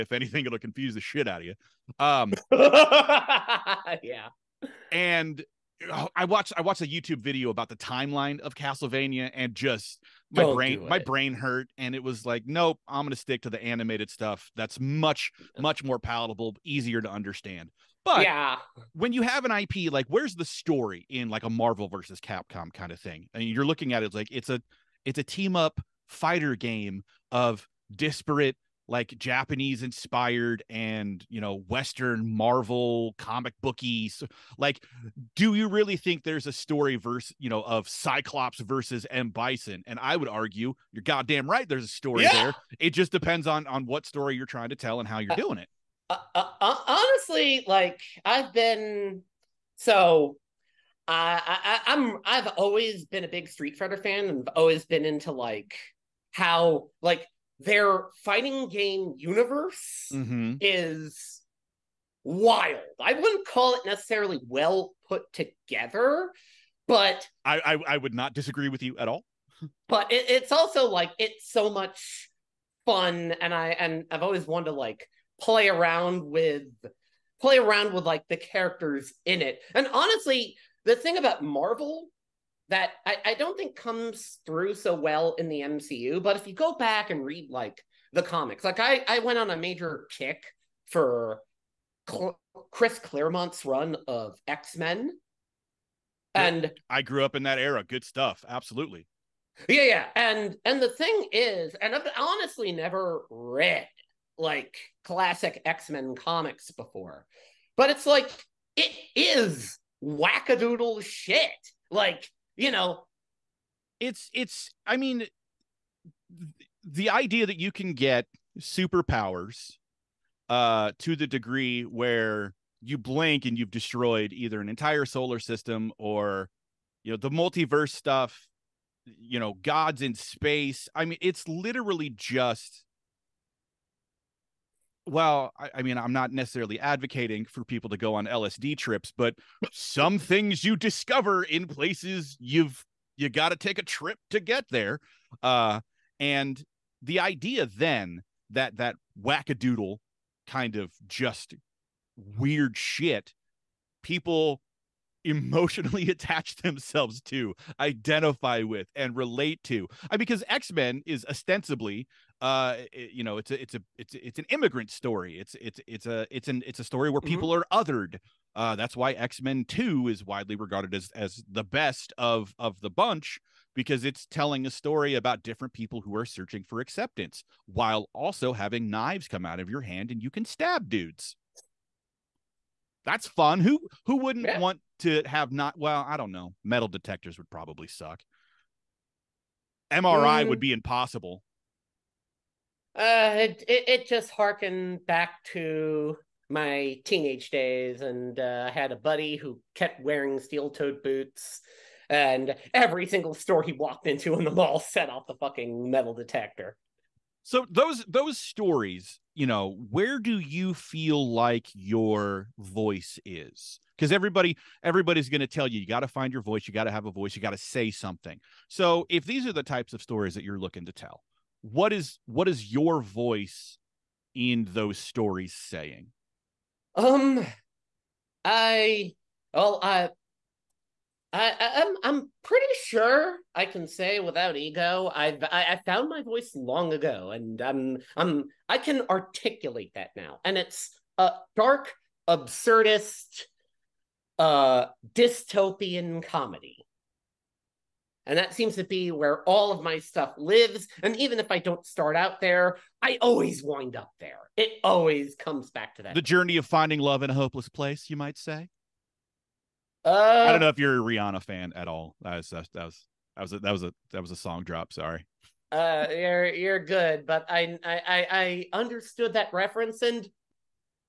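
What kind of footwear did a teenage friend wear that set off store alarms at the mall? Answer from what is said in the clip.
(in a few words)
Steel-toed boots.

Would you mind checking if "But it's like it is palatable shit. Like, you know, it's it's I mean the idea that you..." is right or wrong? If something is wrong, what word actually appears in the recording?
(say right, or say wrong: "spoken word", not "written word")
wrong: "wackadoodle", not "palatable".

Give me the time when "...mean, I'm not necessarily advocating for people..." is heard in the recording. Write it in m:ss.
2:15.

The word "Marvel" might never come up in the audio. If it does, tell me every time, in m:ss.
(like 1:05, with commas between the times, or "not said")
0:21, 0:32, 1:21.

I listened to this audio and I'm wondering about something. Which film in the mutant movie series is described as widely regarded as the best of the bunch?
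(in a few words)
X-Men 2.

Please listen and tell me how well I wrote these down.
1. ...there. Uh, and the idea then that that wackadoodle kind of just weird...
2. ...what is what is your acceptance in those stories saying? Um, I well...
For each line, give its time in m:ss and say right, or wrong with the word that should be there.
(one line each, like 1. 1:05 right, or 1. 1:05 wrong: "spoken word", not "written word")
1. 2:24 right
2. 3:41 wrong: "voice", not "acceptance".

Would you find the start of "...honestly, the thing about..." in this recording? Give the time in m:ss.
1:19.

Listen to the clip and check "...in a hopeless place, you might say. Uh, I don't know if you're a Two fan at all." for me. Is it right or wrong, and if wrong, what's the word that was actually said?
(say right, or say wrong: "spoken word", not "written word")
wrong: "Rihanna", not "Two".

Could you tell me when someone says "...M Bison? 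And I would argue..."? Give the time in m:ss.
0:39.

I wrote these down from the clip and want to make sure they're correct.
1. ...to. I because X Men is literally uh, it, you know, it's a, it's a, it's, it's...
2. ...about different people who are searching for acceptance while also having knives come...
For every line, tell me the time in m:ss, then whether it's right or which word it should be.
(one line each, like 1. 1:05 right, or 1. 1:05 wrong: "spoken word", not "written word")
1. 2:39 wrong: "ostensibly", not "literally"
2. 2:55 right.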